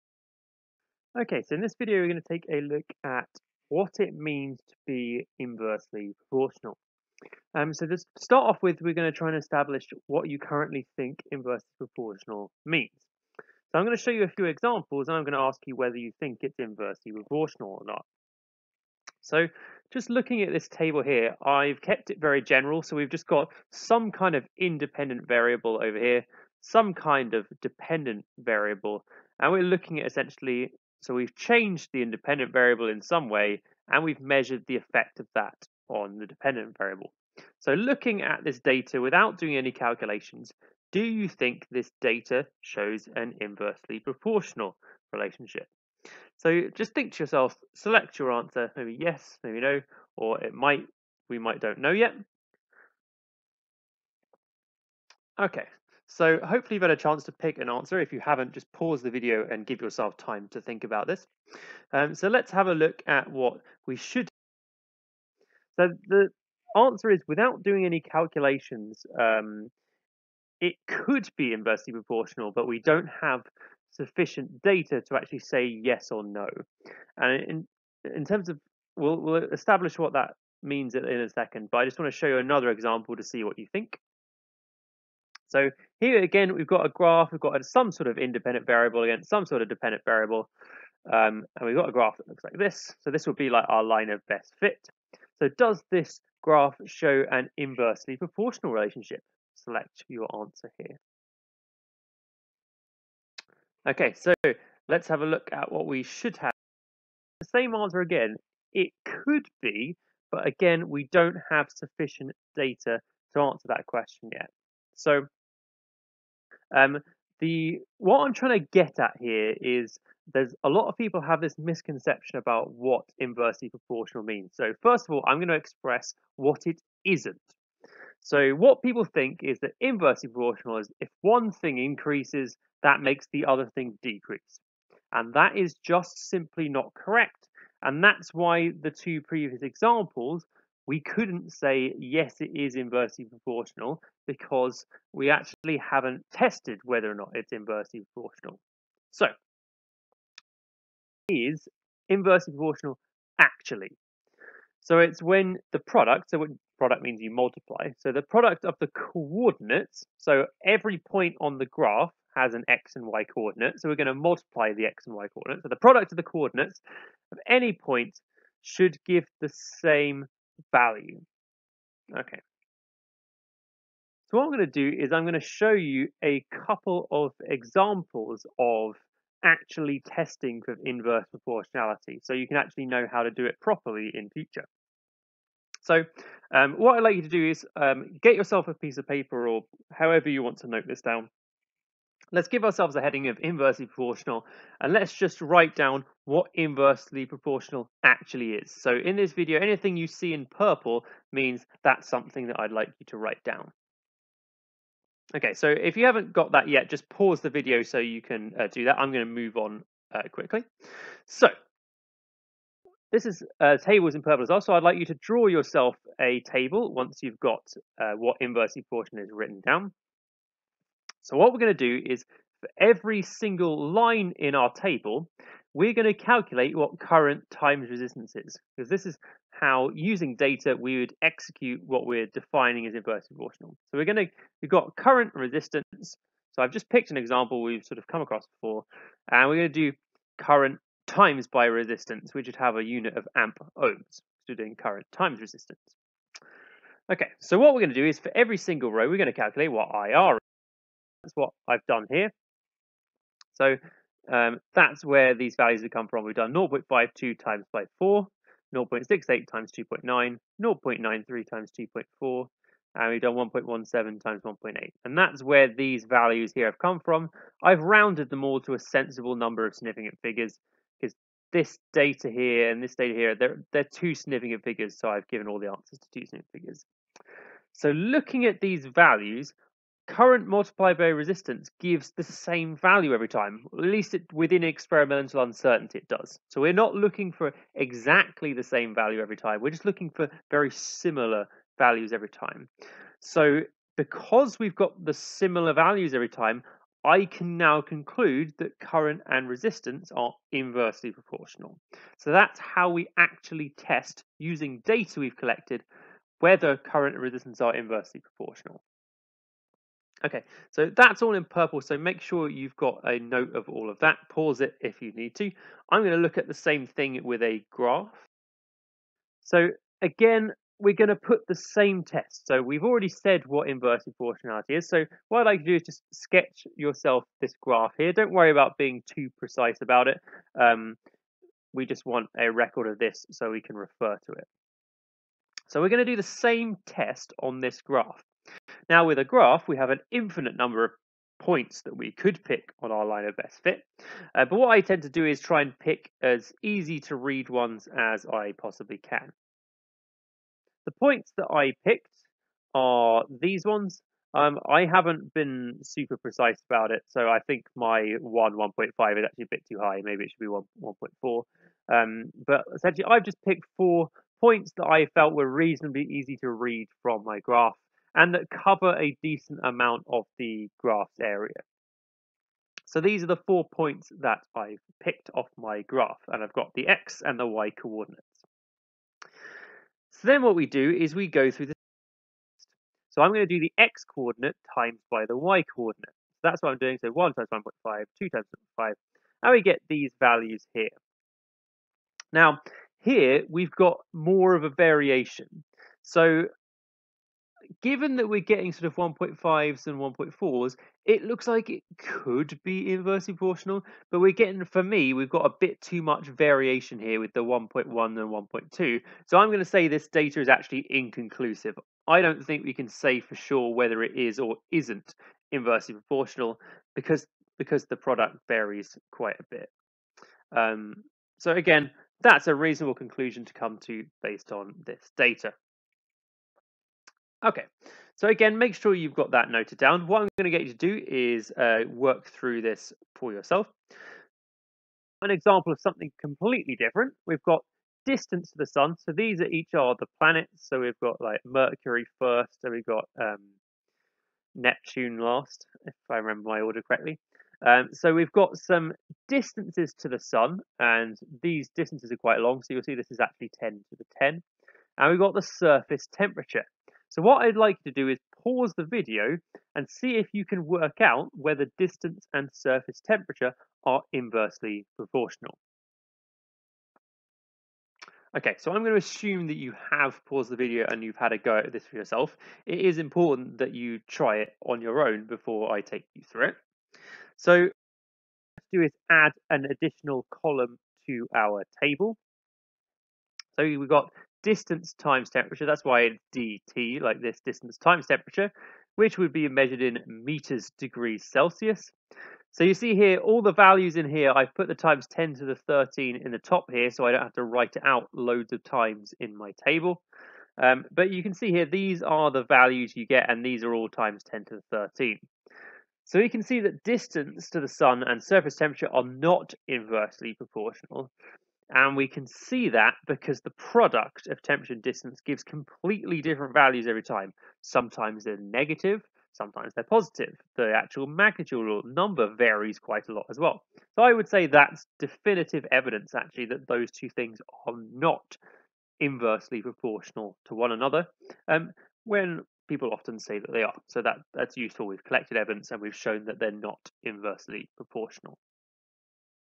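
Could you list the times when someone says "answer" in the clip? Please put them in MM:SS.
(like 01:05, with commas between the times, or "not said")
00:48, 00:57, 01:06, 01:40, 01:47, 01:53, 04:35.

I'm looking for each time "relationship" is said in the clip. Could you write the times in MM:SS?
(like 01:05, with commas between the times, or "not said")
00:45, 01:38.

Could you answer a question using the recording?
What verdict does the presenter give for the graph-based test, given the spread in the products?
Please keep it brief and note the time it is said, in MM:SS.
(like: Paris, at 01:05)
inconclusive, at 06:50.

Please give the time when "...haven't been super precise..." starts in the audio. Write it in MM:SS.
05:54.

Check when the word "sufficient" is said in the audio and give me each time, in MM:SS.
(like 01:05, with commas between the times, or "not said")
01:13, 01:51.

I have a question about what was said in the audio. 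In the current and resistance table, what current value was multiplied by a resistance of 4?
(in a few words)
0.52.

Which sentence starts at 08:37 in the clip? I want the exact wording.
Sometimes they're negative, sometimes they're positive.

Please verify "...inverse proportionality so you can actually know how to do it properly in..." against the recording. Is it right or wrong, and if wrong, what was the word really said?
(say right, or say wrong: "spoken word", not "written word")
right.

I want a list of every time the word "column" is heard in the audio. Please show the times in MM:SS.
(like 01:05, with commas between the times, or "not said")
08:00.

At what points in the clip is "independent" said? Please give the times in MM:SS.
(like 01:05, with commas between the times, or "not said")
00:24, 00:32, 01:28.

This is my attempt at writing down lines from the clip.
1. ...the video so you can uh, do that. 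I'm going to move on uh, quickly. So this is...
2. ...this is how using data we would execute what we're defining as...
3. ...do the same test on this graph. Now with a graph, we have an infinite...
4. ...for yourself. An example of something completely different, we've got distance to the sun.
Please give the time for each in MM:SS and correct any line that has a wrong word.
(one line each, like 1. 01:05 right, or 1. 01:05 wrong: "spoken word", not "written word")
1. 03:27 right
2. 03:48 right
3. 05:36 right
4. 07:13 right.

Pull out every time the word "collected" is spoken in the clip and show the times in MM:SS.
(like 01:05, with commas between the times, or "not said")
05:05, 08:55.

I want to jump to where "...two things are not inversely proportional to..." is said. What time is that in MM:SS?
08:46.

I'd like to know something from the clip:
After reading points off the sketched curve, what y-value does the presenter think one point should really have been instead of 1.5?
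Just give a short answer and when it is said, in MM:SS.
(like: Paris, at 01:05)
1.4, at 06:00.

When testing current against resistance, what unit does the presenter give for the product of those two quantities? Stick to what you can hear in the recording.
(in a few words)
amp ohms.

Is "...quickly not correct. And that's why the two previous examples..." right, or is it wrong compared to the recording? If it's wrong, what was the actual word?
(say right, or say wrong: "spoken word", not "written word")
wrong: "simply", not "quickly".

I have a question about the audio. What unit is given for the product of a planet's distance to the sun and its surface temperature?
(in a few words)
meters degrees Celsius.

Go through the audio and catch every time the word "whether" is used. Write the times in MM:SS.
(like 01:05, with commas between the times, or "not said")
00:15, 02:26, 05:06, 06:53, 07:41.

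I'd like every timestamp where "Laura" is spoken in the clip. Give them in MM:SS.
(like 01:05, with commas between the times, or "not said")
not said.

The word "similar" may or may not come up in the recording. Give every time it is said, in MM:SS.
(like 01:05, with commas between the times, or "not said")
04:50, 04:55.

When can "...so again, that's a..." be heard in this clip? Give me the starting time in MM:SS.
07:01.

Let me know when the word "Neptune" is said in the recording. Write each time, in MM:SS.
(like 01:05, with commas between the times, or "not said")
07:24.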